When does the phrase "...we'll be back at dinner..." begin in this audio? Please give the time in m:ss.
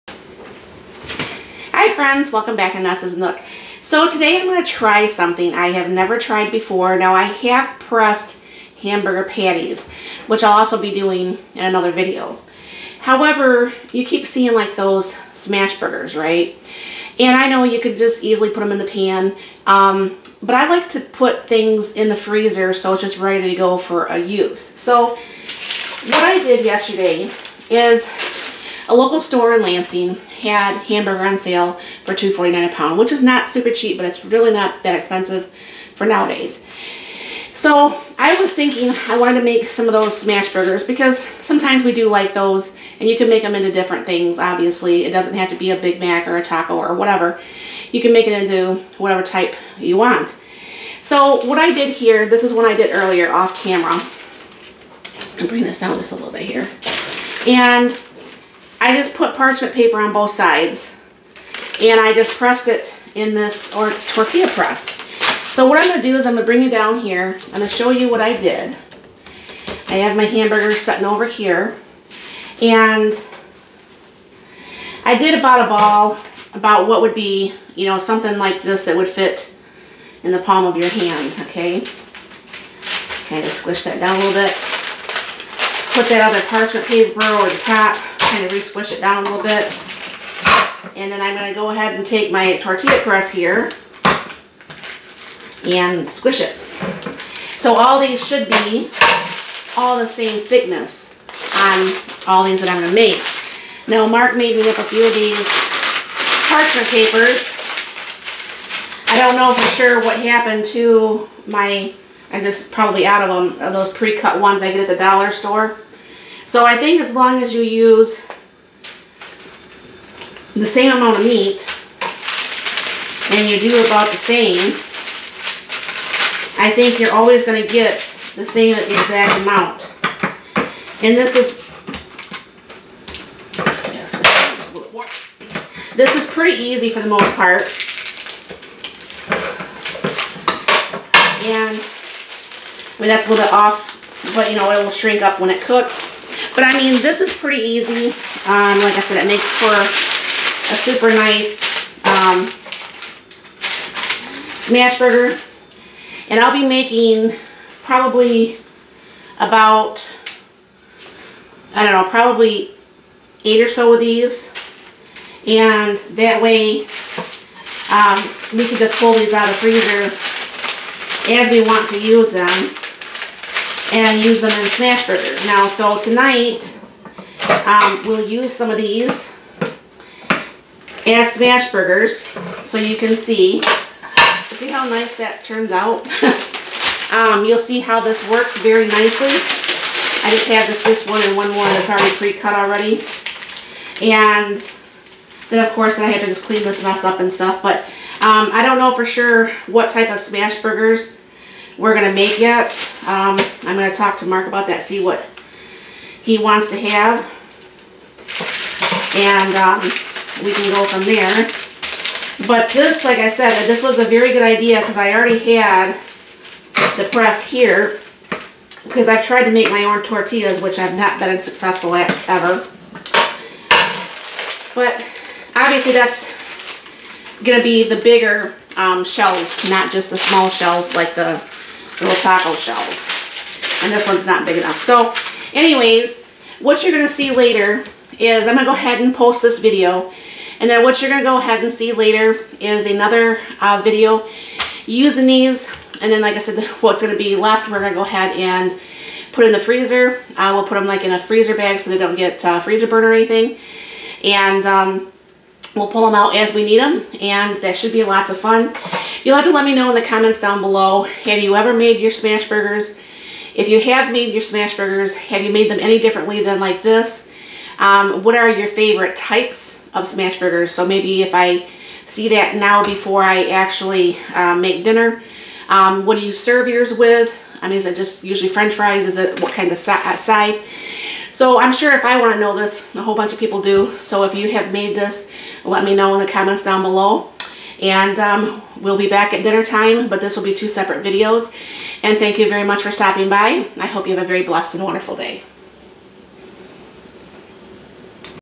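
4:48.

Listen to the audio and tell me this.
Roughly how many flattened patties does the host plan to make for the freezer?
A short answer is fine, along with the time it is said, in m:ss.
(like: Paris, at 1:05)
8, at 2:43.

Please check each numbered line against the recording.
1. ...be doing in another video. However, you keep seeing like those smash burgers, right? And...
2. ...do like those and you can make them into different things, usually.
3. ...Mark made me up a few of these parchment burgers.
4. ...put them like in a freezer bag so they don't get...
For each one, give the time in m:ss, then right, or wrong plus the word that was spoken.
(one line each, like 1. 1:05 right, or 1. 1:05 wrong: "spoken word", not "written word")
1. 0:10 right
2. 0:41 wrong: "obviously", not "usually"
3. 1:44 wrong: "papers", not "burgers"
4. 4:10 right.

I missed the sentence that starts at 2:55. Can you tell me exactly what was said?
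Now, so tonight, um, we'll use some of these as smash burgers so you can see.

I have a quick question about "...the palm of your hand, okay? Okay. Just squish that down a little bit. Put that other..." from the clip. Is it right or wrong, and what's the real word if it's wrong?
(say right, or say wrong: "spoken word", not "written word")
right.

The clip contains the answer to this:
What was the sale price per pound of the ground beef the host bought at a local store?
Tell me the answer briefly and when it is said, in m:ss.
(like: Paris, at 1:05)
$2.49, at 0:32.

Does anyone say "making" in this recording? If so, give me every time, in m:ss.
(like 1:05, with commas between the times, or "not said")
2:36.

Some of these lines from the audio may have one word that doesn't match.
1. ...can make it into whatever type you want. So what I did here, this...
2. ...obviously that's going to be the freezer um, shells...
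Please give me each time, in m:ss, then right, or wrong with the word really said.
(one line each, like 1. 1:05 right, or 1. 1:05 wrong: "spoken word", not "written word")
1. 0:48 right
2. 3:45 wrong: "bigger", not "freezer".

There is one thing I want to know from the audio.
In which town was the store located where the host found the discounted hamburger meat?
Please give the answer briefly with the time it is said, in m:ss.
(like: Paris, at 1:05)
Lansing, at 0:29.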